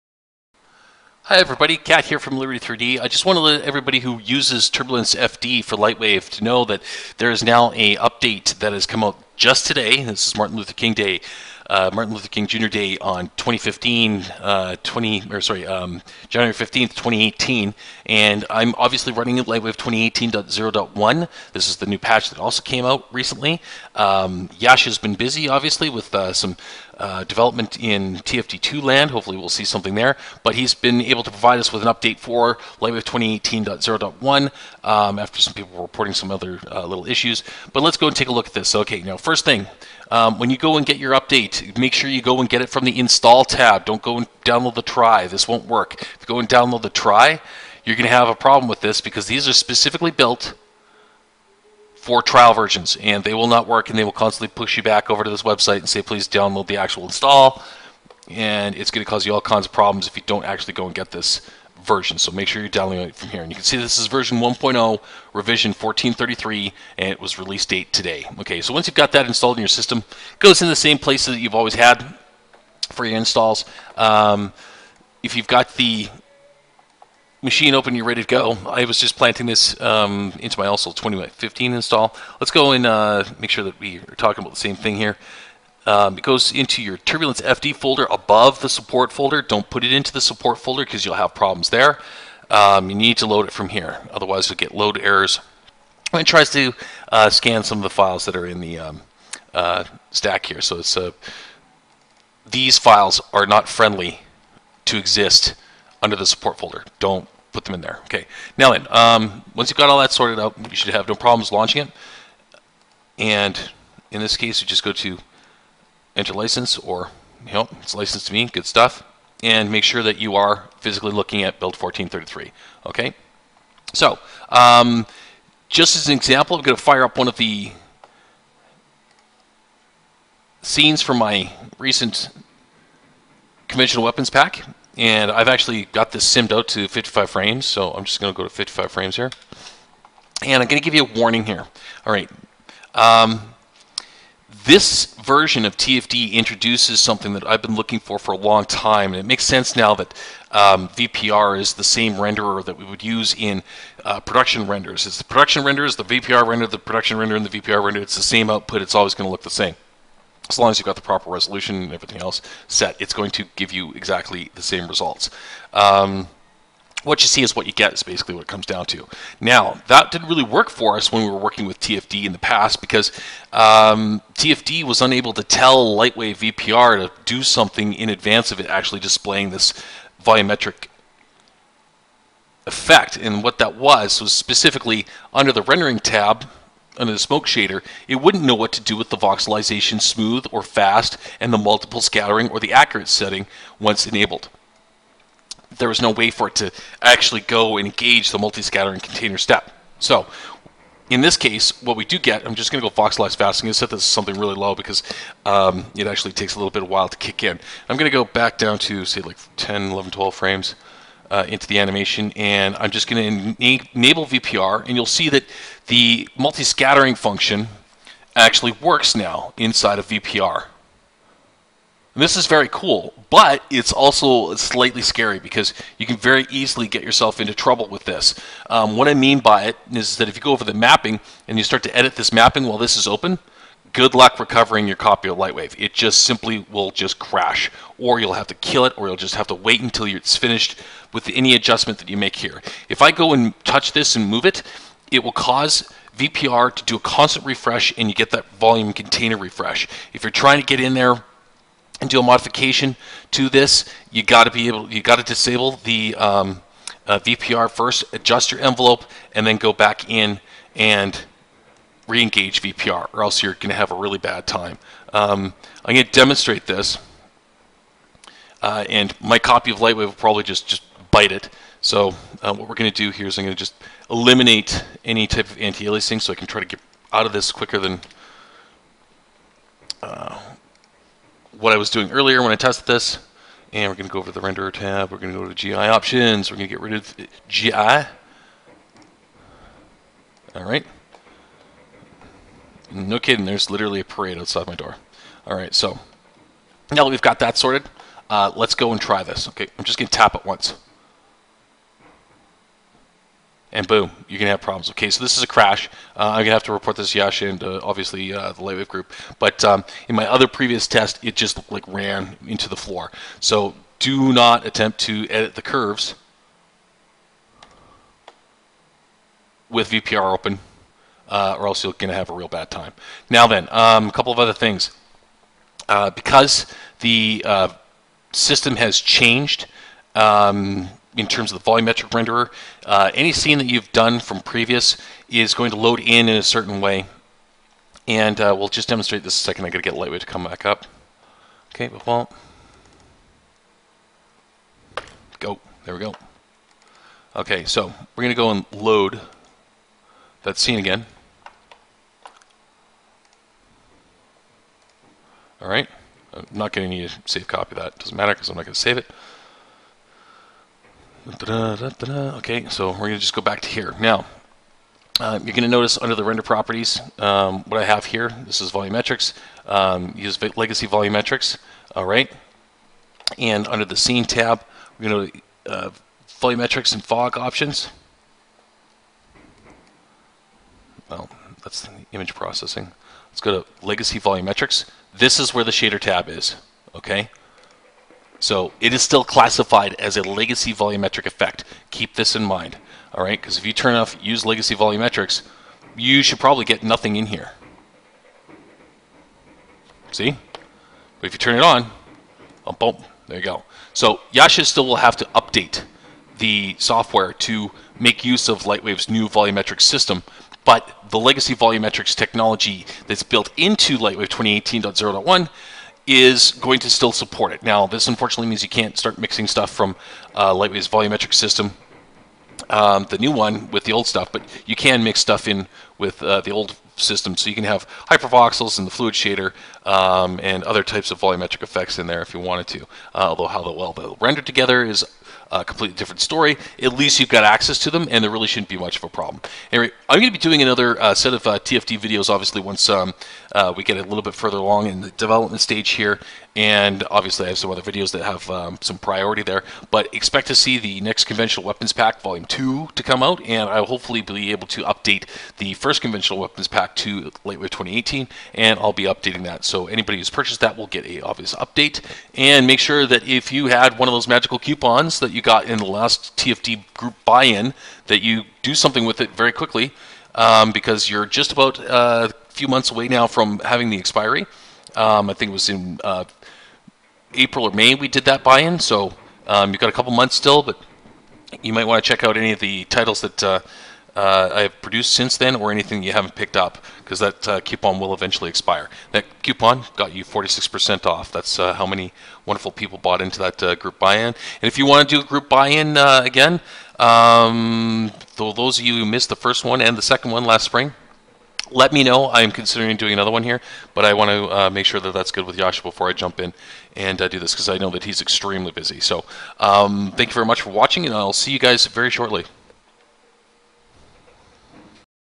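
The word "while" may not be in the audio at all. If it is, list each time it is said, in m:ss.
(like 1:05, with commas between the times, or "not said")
3:26, 3:52.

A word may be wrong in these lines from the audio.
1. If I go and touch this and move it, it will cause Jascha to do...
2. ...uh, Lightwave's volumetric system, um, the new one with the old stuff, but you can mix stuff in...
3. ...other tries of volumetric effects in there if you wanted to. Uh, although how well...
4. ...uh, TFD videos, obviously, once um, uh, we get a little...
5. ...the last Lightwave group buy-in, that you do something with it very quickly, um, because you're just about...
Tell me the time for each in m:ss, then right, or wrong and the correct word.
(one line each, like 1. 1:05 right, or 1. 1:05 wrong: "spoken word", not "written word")
1. 4:02 wrong: "VPR", not "Jascha"
2. 7:00 right
3. 7:10 wrong: "types", not "tries"
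4. 7:21 right
5. 7:45 wrong: "TFD", not "Lightwave".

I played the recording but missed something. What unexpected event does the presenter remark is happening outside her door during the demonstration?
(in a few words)
a parade.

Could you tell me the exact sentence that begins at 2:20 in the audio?
And I'm going to give you a warning here.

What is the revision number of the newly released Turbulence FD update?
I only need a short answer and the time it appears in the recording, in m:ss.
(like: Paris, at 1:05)
1433, at 1:05.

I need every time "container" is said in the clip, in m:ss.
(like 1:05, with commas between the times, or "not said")
3:18, 4:08.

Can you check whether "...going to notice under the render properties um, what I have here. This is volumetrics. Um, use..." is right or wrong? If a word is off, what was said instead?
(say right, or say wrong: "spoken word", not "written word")
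right.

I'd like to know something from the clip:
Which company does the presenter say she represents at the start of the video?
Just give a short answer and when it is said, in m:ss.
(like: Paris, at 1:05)
Liberty 3D, at 0:02.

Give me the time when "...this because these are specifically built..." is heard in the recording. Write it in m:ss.
0:48.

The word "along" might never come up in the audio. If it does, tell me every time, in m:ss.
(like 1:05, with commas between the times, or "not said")
7:24.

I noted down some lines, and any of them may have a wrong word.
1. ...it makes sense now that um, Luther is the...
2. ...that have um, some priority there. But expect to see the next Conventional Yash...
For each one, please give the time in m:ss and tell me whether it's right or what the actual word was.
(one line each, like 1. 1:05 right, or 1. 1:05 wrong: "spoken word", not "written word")
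1. 2:29 wrong: "VPR", not "Luther"
2. 7:28 wrong: "Weapons", not "Yash".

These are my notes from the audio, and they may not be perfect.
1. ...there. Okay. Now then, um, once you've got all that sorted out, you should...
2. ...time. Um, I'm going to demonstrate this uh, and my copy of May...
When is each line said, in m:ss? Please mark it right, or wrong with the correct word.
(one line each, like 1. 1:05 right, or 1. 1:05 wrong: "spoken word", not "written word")
1. 1:47 right
2. 4:24 wrong: "Lightwave", not "May".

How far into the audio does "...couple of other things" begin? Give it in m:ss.
5:24.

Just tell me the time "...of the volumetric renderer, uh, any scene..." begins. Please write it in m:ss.
5:31.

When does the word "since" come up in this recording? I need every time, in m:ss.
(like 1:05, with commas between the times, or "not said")
8:05.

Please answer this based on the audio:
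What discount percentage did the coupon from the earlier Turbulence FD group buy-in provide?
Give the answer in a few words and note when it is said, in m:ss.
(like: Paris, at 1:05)
46%, at 8:10.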